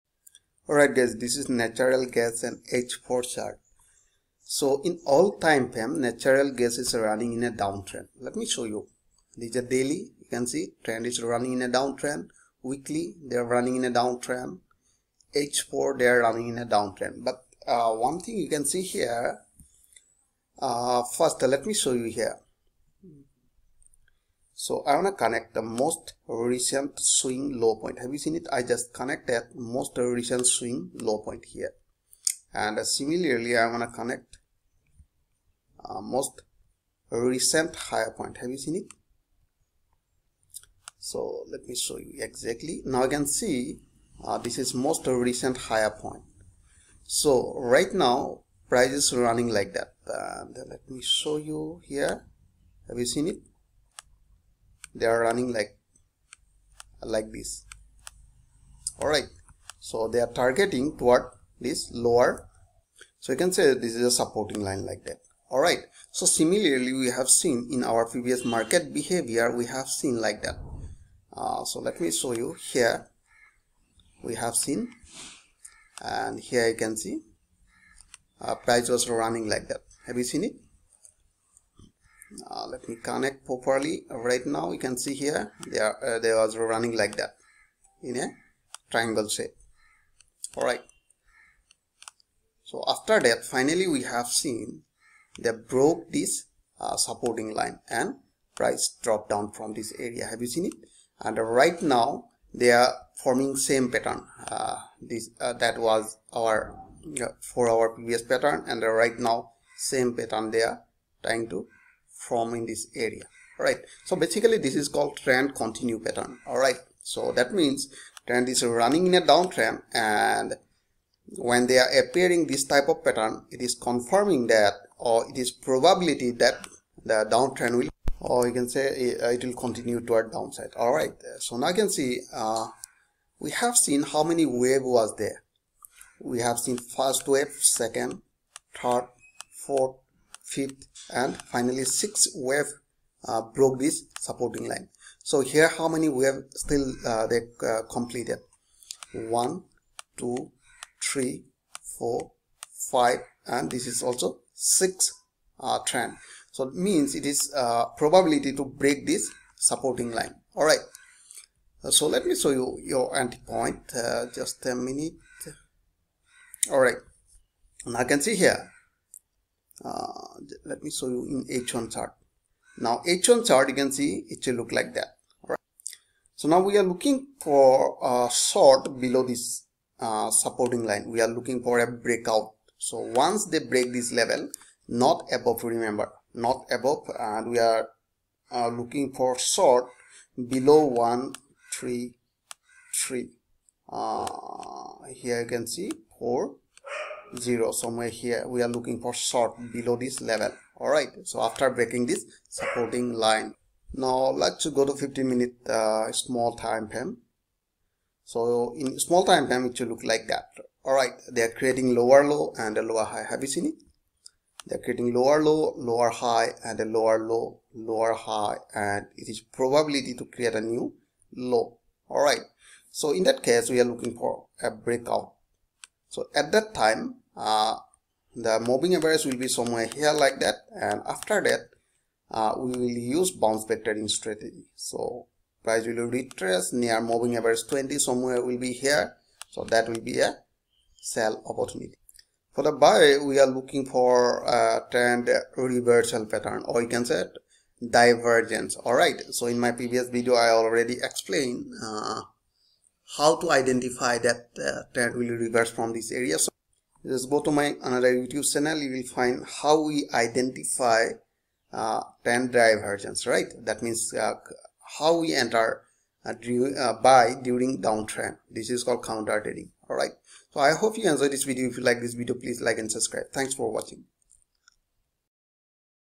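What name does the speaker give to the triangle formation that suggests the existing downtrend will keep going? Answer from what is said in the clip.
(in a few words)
Trend continue pattern.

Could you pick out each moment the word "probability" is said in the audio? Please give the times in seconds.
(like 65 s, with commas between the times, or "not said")
125 s, 157 s, 219 s.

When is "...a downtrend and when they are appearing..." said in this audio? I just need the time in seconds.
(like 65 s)
119 s.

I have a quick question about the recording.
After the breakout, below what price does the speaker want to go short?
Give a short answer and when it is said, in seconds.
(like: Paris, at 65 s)
133, at 190 s.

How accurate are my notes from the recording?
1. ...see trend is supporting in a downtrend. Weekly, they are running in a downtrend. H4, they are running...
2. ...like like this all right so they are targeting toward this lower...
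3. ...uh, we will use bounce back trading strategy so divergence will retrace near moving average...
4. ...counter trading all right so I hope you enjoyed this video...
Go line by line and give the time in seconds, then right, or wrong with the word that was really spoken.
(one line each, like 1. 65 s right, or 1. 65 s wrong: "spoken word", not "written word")
1. 10 s wrong: "running", not "supporting"
2. 55 s right
3. 232 s wrong: "price", not "divergence"
4. 269 s right.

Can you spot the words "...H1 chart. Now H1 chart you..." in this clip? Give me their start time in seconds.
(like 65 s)
171 s.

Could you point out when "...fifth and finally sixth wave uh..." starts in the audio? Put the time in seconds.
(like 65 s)
140 s.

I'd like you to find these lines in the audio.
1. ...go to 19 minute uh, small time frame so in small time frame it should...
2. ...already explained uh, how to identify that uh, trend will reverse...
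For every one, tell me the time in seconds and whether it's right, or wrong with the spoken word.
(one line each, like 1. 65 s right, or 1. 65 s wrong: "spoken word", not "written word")
1. 204 s wrong: "15", not "19"
2. 250 s right.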